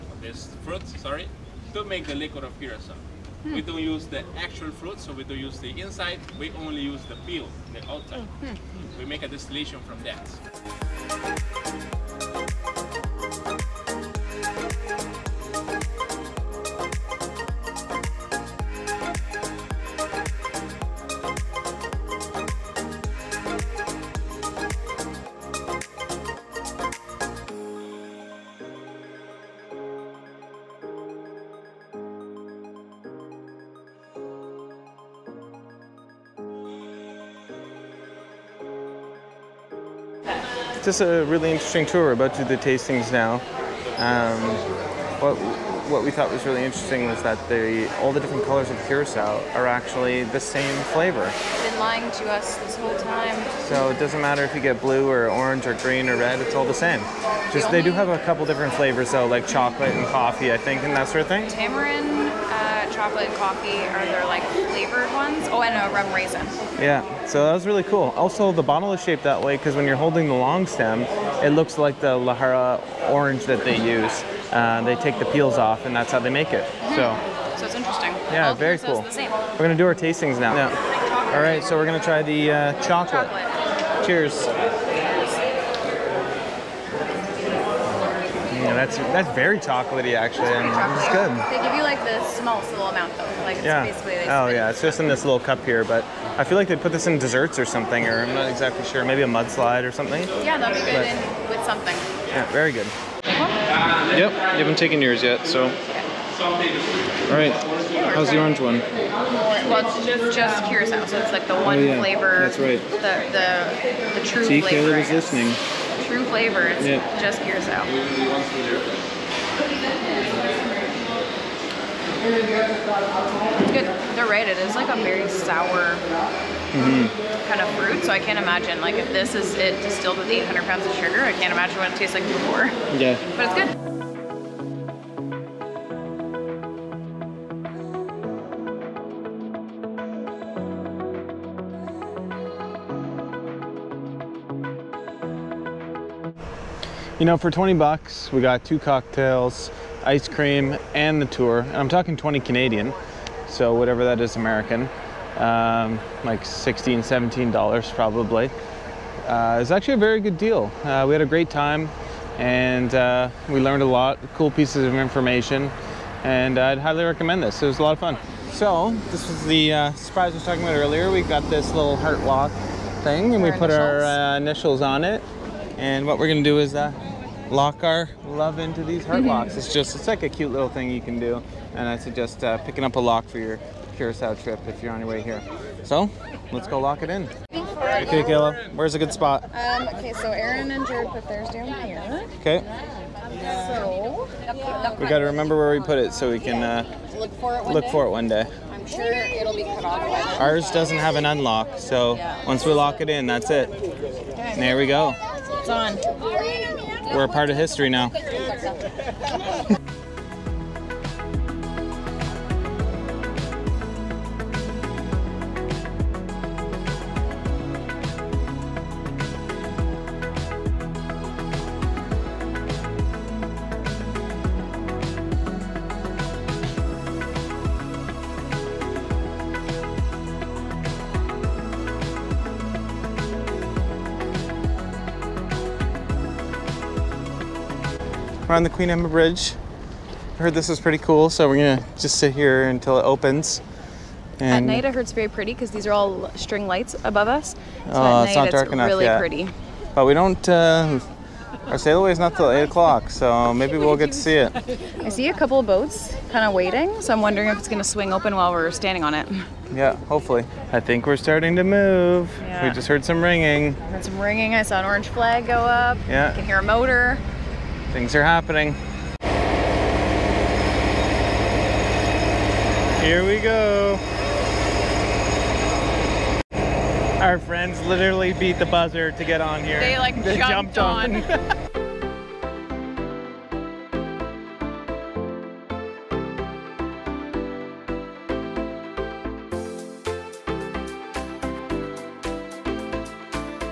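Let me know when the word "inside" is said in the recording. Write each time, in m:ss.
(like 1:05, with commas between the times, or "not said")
0:05.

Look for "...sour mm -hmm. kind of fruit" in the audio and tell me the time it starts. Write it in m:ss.
2:05.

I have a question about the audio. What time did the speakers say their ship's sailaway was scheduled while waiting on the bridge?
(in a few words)
8 o'clock.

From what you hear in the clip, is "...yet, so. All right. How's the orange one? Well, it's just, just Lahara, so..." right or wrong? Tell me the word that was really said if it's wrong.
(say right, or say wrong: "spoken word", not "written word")
wrong: "Curacao", not "Lahara".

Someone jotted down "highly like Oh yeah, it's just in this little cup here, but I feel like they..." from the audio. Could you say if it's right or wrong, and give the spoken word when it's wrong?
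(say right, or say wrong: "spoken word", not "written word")
wrong: "basically", not "highly".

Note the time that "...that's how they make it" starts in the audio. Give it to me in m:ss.
1:15.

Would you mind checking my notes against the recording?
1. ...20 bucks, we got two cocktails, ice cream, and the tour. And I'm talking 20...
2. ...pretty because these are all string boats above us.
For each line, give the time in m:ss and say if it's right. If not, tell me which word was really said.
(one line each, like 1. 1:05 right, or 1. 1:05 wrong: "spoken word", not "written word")
1. 2:27 right
2. 4:05 wrong: "lights", not "boats".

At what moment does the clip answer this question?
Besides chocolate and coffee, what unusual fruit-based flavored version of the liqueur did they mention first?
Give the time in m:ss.
1:01.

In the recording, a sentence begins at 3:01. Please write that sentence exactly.
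And I suggest uh, picking up a lock for your Curacao trip if you're on your way here.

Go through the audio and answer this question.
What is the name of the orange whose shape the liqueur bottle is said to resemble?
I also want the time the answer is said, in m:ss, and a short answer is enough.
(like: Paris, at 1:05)
Lahara orange, at 1:12.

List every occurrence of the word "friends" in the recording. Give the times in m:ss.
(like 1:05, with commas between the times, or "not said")
4:37.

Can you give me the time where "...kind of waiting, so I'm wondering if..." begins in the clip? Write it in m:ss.
4:16.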